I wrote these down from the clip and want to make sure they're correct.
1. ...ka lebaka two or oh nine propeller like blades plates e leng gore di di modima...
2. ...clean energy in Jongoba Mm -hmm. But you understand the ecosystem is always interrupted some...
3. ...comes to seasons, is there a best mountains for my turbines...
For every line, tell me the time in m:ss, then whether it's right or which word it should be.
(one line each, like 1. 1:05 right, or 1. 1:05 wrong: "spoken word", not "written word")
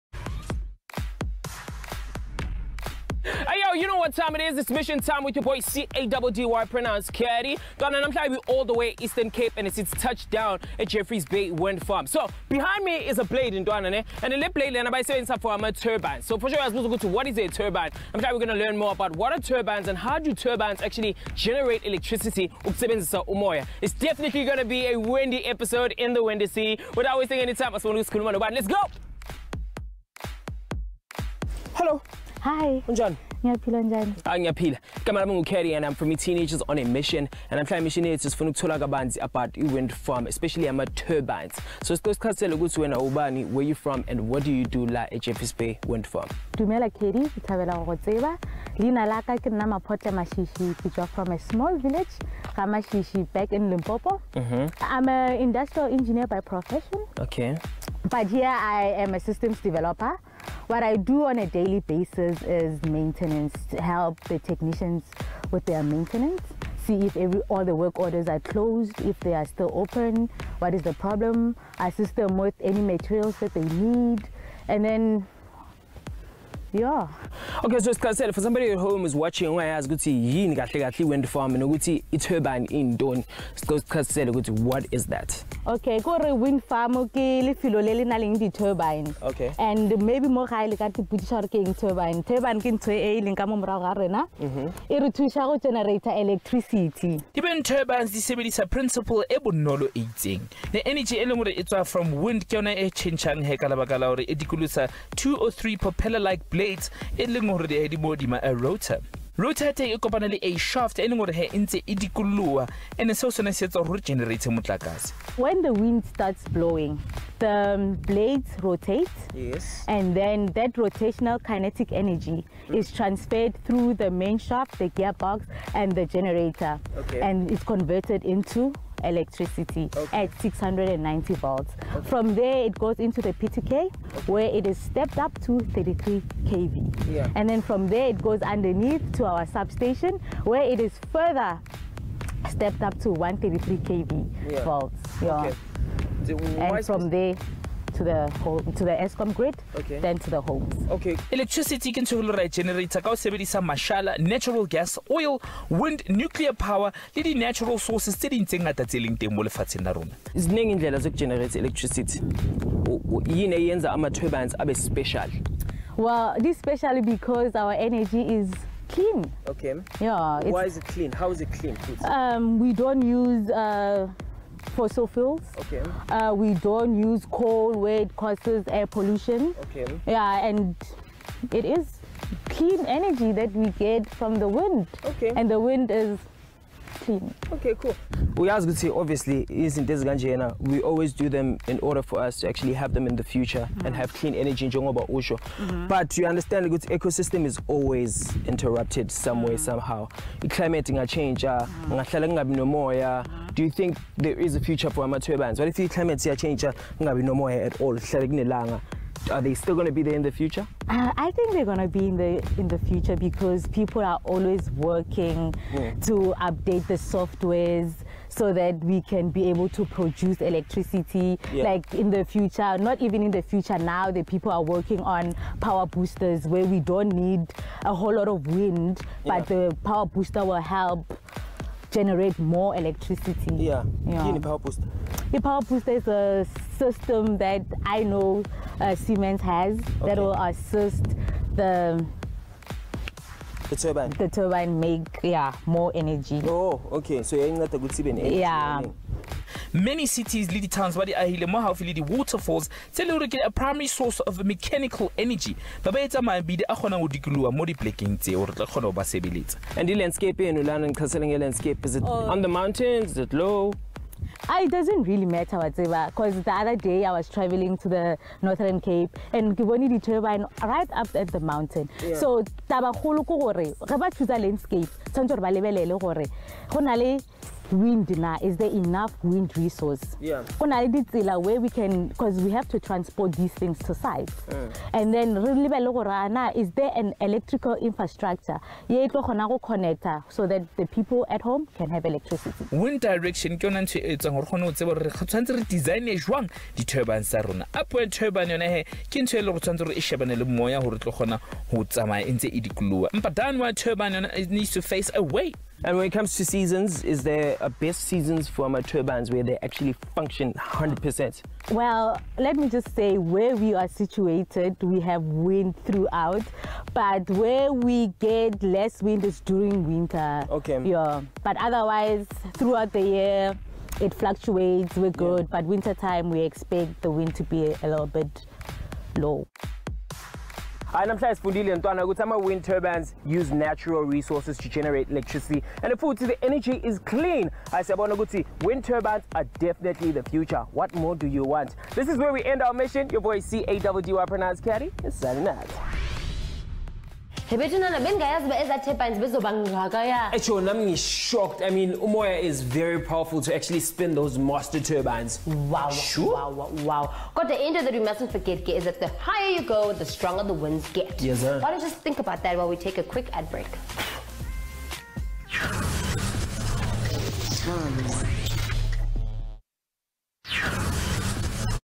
1. 1:43 wrong: "three", not "nine"
2. 3:14 right
3. 5:06 wrong: "seasons", not "mountains".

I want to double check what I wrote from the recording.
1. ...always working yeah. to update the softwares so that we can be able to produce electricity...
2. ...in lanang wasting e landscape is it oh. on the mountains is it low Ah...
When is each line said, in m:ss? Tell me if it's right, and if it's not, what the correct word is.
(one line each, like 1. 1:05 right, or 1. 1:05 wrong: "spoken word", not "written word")
1. 3:34 right
2. 4:20 wrong: "tlhaseleng", not "wasting".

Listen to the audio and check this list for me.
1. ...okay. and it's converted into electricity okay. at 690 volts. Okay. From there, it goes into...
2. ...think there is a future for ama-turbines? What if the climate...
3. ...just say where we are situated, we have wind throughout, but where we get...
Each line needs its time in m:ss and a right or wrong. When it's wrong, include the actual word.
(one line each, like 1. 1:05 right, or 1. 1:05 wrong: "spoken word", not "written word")
1. 2:06 right
2. 3:23 right
3. 5:12 right.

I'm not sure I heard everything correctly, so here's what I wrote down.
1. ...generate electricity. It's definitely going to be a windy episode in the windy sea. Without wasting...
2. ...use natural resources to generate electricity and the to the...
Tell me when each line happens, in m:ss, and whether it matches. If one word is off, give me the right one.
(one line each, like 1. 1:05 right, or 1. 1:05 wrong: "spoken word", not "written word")
1. 0:21 right
2. 5:33 right.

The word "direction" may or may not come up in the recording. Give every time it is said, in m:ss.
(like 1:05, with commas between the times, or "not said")
4:53.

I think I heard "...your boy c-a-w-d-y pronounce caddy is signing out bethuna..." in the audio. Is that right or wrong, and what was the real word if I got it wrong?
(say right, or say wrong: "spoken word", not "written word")
right.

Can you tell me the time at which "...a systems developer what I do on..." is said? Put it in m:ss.
0:59.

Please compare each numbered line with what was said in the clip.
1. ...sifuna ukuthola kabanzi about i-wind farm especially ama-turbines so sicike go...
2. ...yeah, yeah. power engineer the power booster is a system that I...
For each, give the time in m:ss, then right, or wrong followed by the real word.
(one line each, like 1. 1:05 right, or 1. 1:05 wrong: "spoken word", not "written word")
1. 0:38 right
2. 3:53 wrong: "booster", not "engineer".